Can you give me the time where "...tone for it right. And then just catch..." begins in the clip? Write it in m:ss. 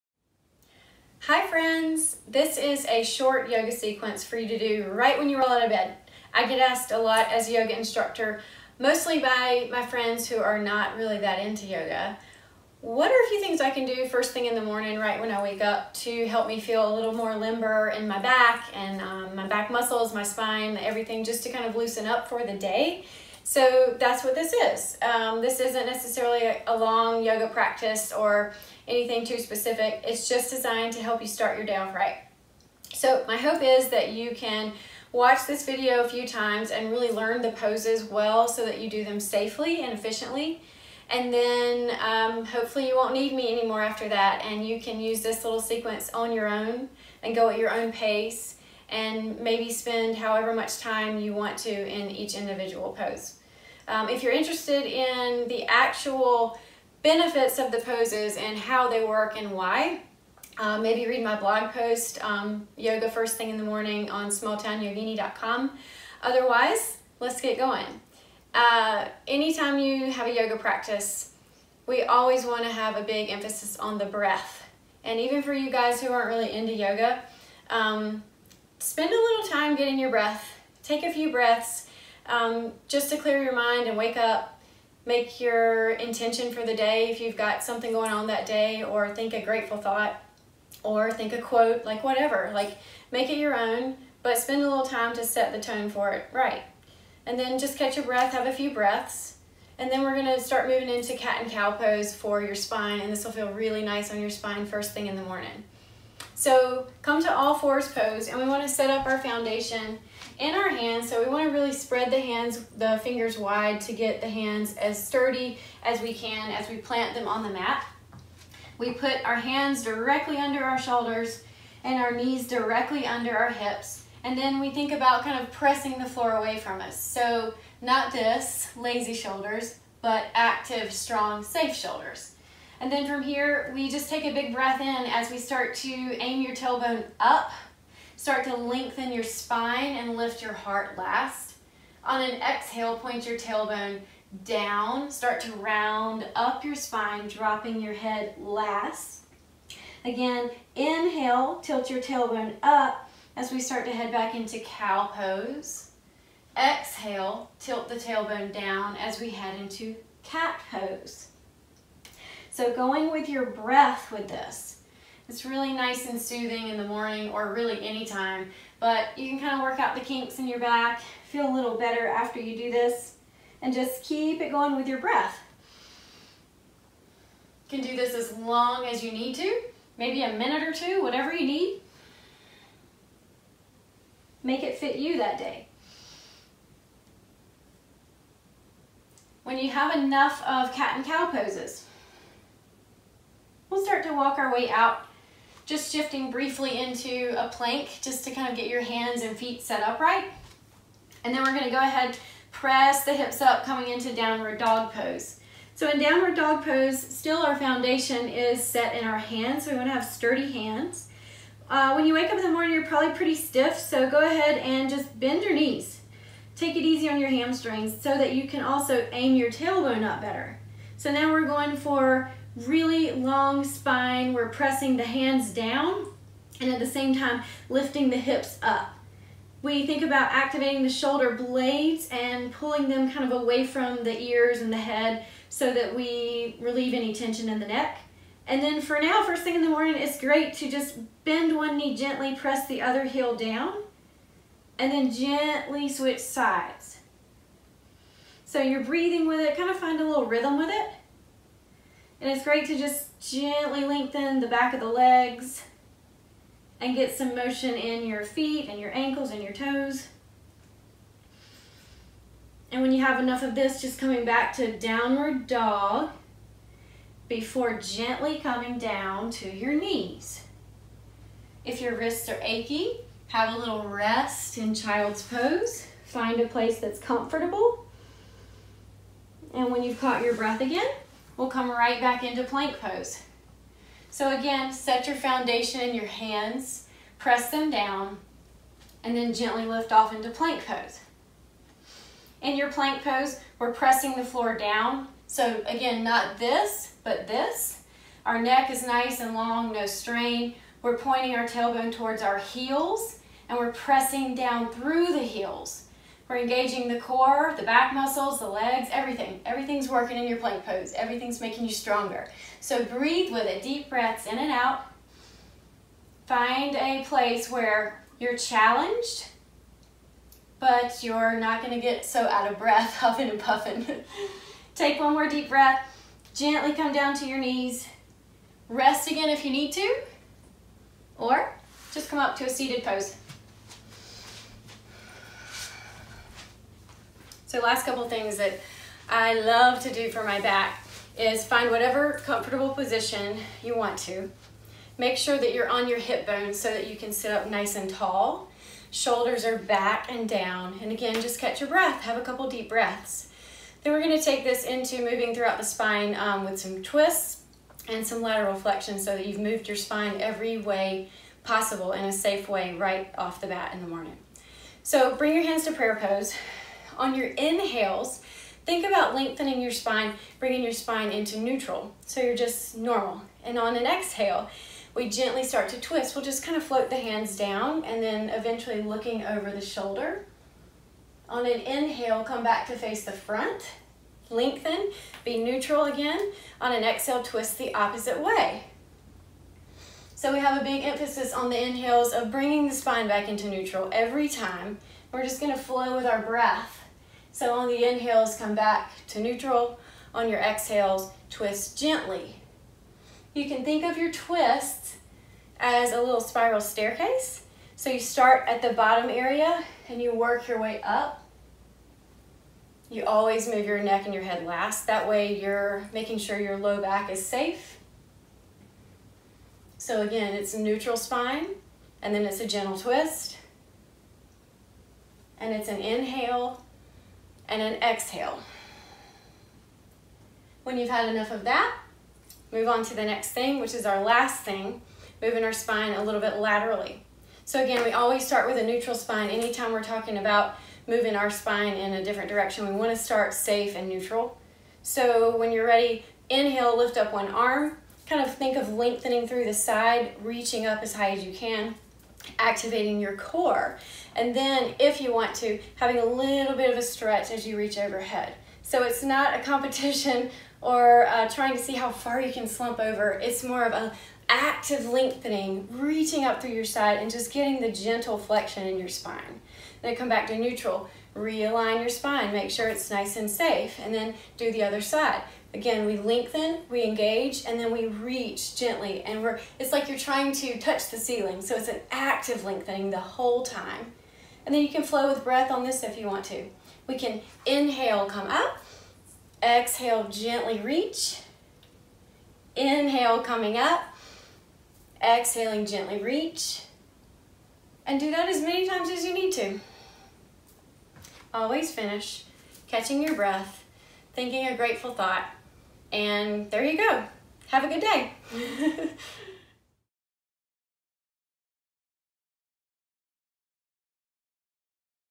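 1:35.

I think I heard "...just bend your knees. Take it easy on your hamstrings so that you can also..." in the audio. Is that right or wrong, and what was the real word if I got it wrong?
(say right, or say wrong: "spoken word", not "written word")
right.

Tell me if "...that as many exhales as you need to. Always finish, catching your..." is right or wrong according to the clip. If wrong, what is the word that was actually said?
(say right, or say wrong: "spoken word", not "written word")
wrong: "times", not "exhales".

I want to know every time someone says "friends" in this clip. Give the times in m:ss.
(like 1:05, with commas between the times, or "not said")
0:01, 0:09.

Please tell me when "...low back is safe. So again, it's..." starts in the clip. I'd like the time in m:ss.
6:56.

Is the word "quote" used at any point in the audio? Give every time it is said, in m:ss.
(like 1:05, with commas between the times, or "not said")
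1:31.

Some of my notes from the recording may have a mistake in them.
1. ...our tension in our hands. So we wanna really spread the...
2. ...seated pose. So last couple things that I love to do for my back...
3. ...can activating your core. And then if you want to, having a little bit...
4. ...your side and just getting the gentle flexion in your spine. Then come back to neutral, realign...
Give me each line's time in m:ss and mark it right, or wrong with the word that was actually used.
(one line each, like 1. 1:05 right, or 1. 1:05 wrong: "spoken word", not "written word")
1. 1:49 wrong: "foundation", not "tension"
2. 5:32 right
3. 7:31 right
4. 7:46 right.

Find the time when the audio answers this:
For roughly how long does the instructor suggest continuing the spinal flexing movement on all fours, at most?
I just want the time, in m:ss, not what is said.
2:59.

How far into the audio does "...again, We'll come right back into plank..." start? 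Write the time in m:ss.
4:40.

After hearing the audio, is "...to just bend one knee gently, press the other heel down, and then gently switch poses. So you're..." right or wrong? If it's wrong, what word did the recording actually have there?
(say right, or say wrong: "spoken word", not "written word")
wrong: "sides", not "poses".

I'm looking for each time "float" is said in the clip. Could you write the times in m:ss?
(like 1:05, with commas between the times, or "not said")
6:16.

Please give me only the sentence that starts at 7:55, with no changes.
Again, we lengthen, we engage, and then we reach gently.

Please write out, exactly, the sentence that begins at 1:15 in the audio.
And even for you guys who aren't really into yoga, um, spend a little time getting your breath.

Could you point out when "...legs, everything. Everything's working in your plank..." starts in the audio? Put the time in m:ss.
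5:08.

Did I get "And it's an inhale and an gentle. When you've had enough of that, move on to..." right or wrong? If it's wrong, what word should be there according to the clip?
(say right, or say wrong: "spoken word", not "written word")
wrong: "exhale", not "gentle".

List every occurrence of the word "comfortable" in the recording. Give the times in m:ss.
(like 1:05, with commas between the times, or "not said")
4:36, 5:42.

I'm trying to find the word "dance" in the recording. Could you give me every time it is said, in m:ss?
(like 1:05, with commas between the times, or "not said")
not said.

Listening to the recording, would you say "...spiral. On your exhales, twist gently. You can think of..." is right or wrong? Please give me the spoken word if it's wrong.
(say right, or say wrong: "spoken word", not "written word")
wrong: "neutral", not "spiral".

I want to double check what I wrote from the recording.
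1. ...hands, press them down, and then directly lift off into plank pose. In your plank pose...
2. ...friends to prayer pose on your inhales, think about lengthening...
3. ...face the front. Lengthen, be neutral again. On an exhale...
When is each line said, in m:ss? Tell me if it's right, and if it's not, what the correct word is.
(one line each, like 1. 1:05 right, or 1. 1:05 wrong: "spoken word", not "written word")
1. 4:46 wrong: "gently", not "directly"
2. 6:05 wrong: "hands", not "friends"
3. 6:22 right.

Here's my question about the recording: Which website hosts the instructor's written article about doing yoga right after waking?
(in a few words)
smalltownyogini.com.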